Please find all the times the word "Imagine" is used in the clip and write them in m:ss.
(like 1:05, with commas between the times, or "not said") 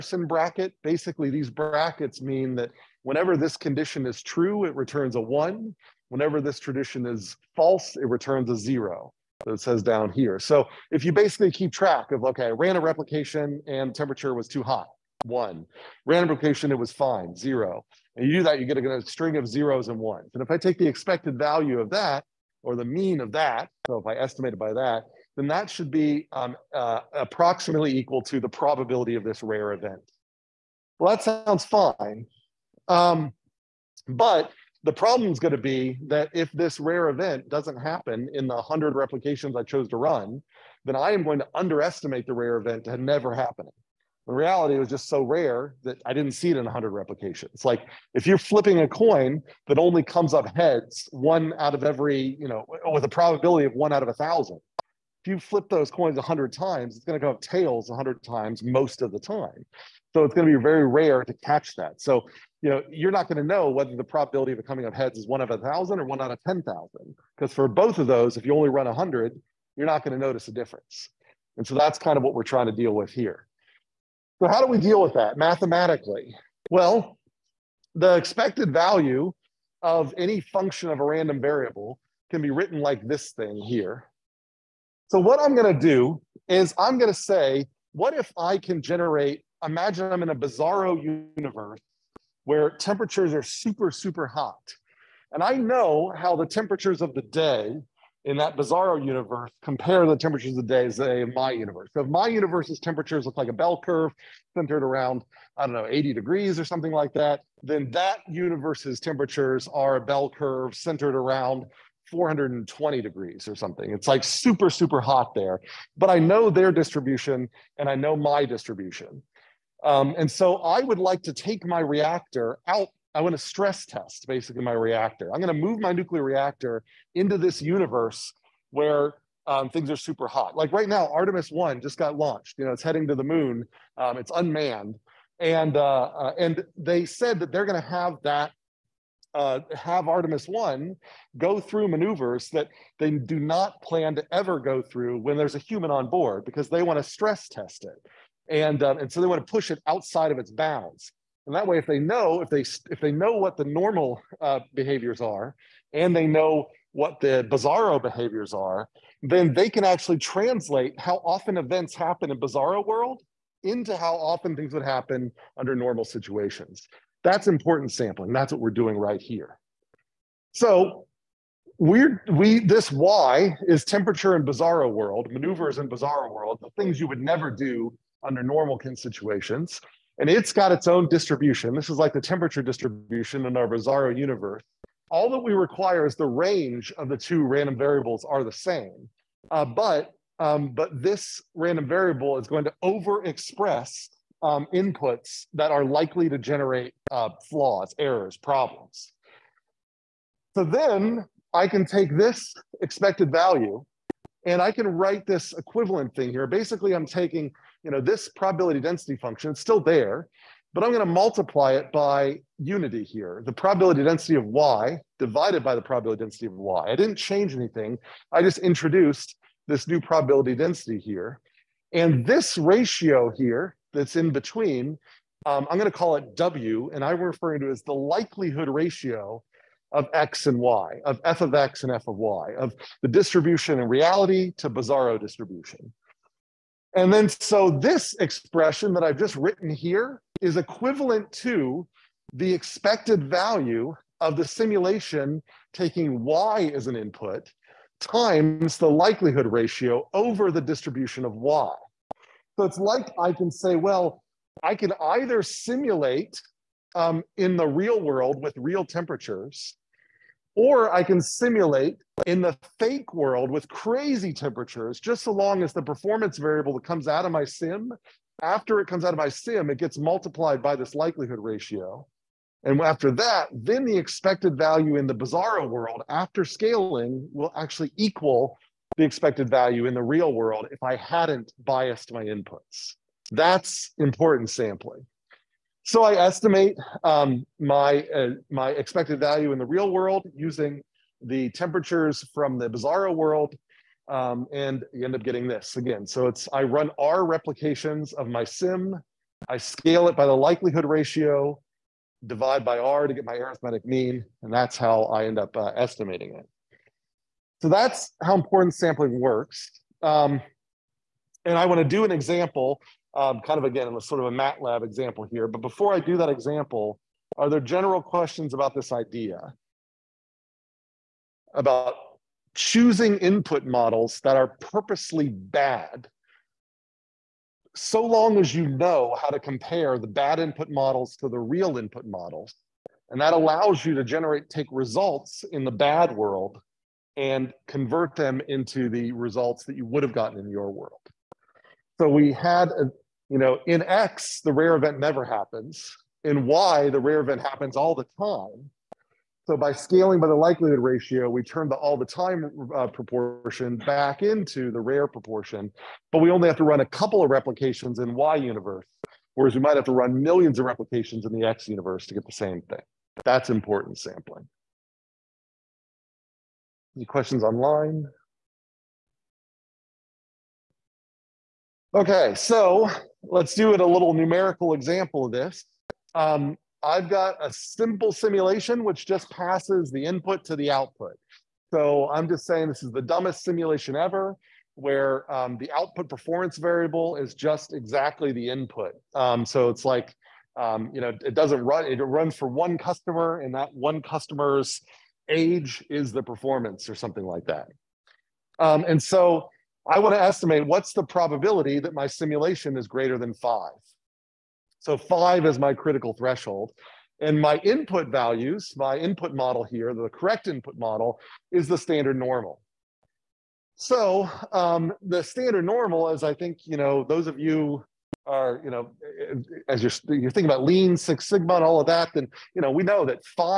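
1:29.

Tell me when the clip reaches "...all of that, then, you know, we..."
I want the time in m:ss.
7:01.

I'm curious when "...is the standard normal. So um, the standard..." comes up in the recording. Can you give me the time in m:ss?
6:51.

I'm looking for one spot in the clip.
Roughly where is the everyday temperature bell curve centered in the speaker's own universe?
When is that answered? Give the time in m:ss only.
1:45.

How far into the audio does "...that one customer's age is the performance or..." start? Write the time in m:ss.
6:33.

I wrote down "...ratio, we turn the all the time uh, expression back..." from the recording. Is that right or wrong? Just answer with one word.
wrong.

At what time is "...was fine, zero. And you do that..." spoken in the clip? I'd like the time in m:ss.
0:16.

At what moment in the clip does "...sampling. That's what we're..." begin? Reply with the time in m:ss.
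2:47.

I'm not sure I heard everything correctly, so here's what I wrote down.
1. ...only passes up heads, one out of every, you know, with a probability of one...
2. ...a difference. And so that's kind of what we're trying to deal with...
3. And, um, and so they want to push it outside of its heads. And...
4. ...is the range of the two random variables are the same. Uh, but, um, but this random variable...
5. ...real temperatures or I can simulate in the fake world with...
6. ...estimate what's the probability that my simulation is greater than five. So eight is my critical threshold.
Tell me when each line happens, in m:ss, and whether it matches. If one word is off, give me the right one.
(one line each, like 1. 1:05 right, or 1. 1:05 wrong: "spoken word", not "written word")
1. 0:49 wrong: "comes", not "passes"
2. 1:10 right
3. 2:28 wrong: "bounds", not "heads"
4. 3:06 right
5. 4:18 right
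6. 6:40 wrong: "five", not "eight".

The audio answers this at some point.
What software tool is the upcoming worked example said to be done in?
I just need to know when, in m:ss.
5:14.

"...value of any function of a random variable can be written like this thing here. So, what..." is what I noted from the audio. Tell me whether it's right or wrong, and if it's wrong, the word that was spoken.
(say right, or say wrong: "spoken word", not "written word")
right.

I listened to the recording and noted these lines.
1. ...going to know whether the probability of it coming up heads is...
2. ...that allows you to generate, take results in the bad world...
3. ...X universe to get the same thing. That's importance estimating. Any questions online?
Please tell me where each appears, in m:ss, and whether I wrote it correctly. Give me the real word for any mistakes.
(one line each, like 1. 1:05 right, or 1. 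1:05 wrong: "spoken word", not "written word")
1. 1:03 right
2. 5:33 right
3. 6:01 wrong: "sampling", not "estimating".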